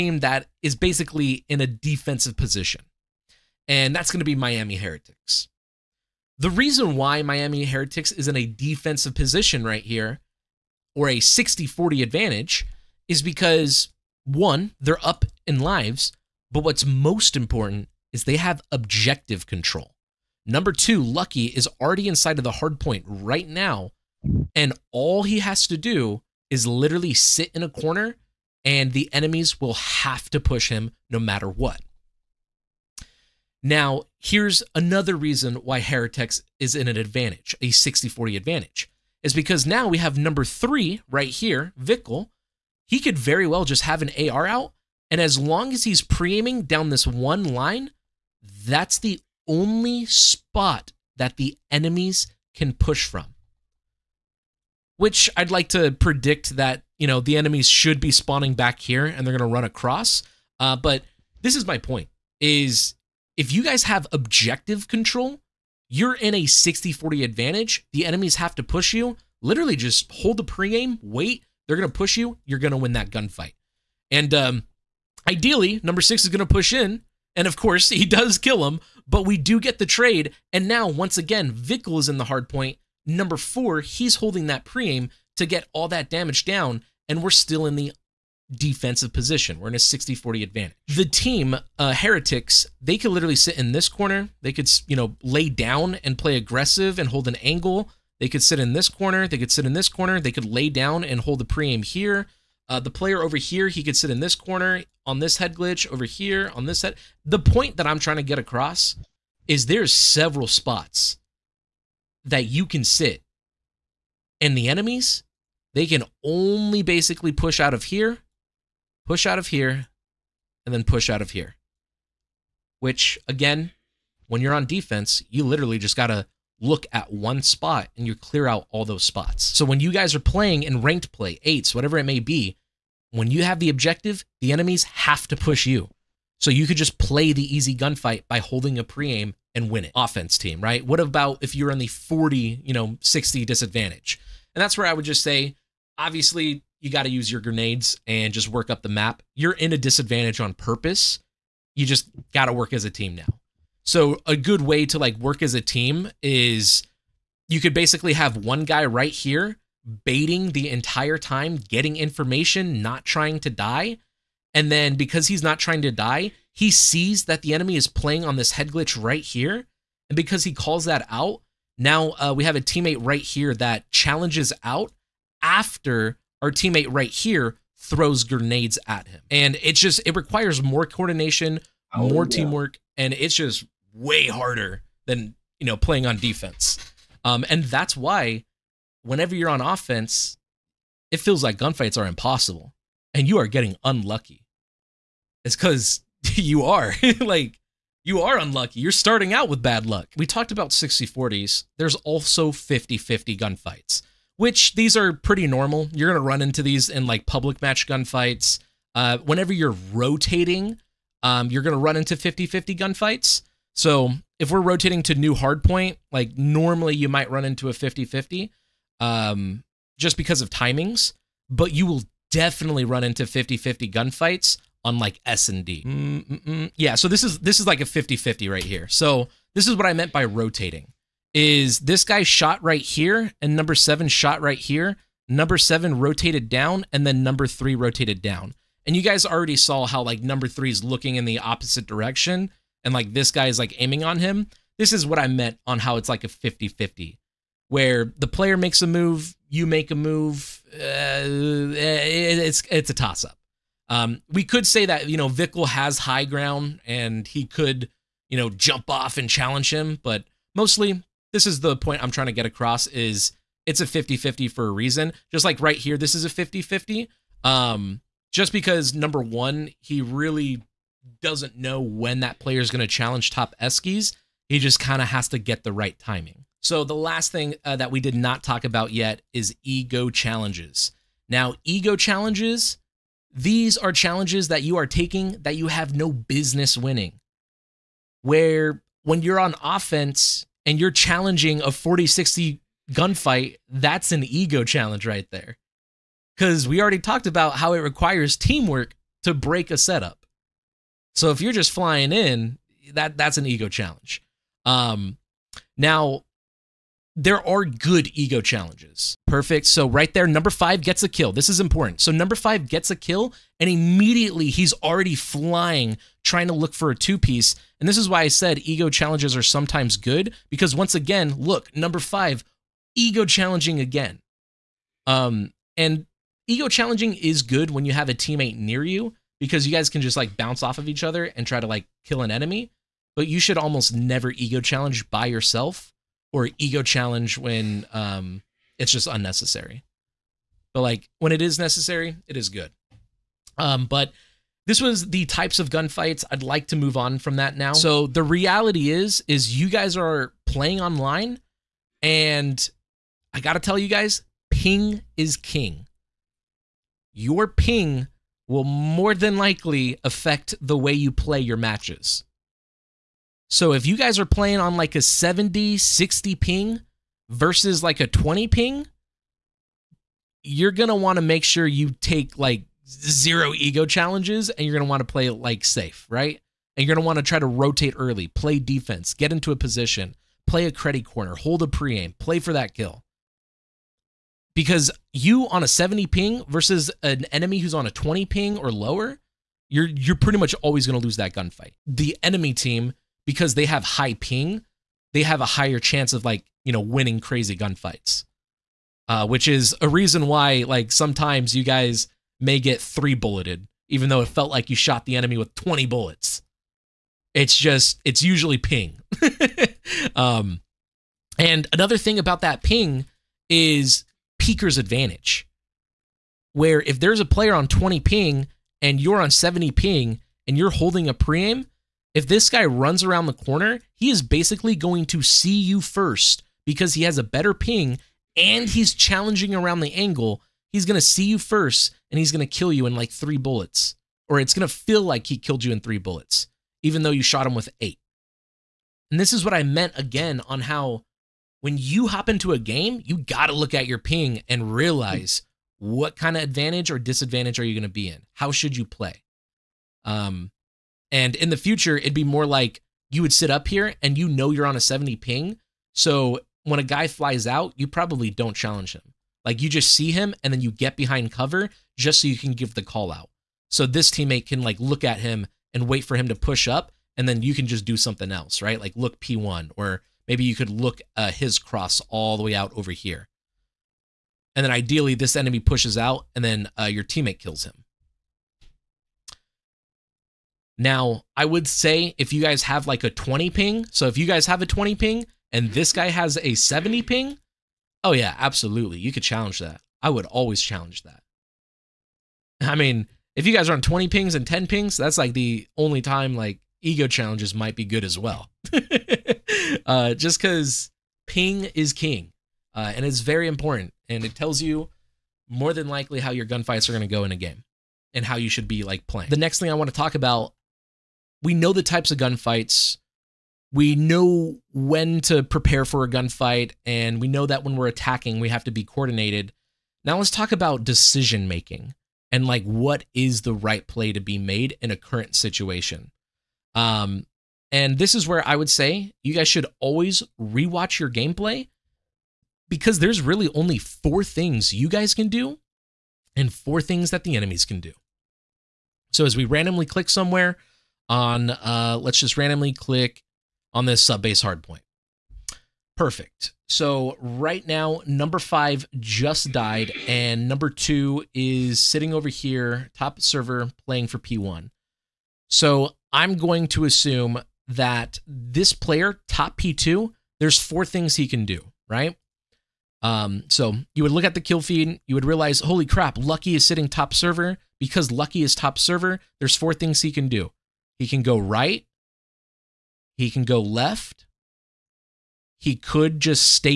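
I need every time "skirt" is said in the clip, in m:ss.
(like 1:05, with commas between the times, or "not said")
not said.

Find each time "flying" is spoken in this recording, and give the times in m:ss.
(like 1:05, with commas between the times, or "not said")
5:01, 5:15.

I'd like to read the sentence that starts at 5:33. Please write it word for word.
But you should almost never ego challenge by yourself or ego challenge when um, it's just unnecessary.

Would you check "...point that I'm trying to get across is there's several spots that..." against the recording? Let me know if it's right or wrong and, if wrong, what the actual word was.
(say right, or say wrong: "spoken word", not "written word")
right.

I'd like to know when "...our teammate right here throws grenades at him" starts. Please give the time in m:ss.
2:56.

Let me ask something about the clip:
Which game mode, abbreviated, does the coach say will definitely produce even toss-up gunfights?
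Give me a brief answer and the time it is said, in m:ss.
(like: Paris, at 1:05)
S and D, at 3:45.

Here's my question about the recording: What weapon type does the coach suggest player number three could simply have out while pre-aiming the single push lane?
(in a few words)
AR.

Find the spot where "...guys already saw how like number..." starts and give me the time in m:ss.
3:59.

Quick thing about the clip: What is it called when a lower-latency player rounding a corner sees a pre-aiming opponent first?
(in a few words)
Peaker's advantage.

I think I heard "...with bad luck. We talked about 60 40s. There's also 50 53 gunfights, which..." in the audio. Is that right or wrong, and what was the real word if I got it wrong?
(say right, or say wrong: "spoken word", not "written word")
wrong: "50", not "53".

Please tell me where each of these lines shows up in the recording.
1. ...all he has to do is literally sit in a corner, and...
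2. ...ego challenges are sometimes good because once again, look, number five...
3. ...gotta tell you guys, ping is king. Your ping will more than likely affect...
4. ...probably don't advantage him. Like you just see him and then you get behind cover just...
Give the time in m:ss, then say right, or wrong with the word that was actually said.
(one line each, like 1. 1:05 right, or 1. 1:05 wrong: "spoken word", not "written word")
1. 0:24 right
2. 5:18 right
3. 5:53 right
4. 7:37 wrong: "challenge", not "advantage".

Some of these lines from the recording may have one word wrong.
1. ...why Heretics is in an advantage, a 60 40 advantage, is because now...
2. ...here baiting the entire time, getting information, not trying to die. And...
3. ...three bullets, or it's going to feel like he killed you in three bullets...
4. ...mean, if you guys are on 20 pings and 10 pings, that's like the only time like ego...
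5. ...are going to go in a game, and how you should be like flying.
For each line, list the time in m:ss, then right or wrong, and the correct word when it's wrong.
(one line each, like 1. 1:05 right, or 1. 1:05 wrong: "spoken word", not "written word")
1. 0:35 right
2. 2:39 right
3. 7:13 right
4. 8:12 right
5. 8:26 wrong: "playing", not "flying".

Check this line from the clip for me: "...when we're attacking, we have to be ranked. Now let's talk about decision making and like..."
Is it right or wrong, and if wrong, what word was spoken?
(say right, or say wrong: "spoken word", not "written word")
wrong: "coordinated", not "ranked".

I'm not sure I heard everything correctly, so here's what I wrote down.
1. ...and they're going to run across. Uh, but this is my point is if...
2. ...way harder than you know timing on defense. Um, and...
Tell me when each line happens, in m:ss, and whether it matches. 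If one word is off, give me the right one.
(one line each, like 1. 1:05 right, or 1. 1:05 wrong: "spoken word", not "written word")
1. 0:59 right
2. 3:03 wrong: "playing", not "timing".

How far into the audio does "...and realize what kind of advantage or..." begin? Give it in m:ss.
7:24.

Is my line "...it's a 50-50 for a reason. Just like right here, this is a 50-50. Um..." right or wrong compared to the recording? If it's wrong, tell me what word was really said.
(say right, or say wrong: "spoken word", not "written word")
right.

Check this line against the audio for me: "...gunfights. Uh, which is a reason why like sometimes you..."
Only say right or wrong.
right.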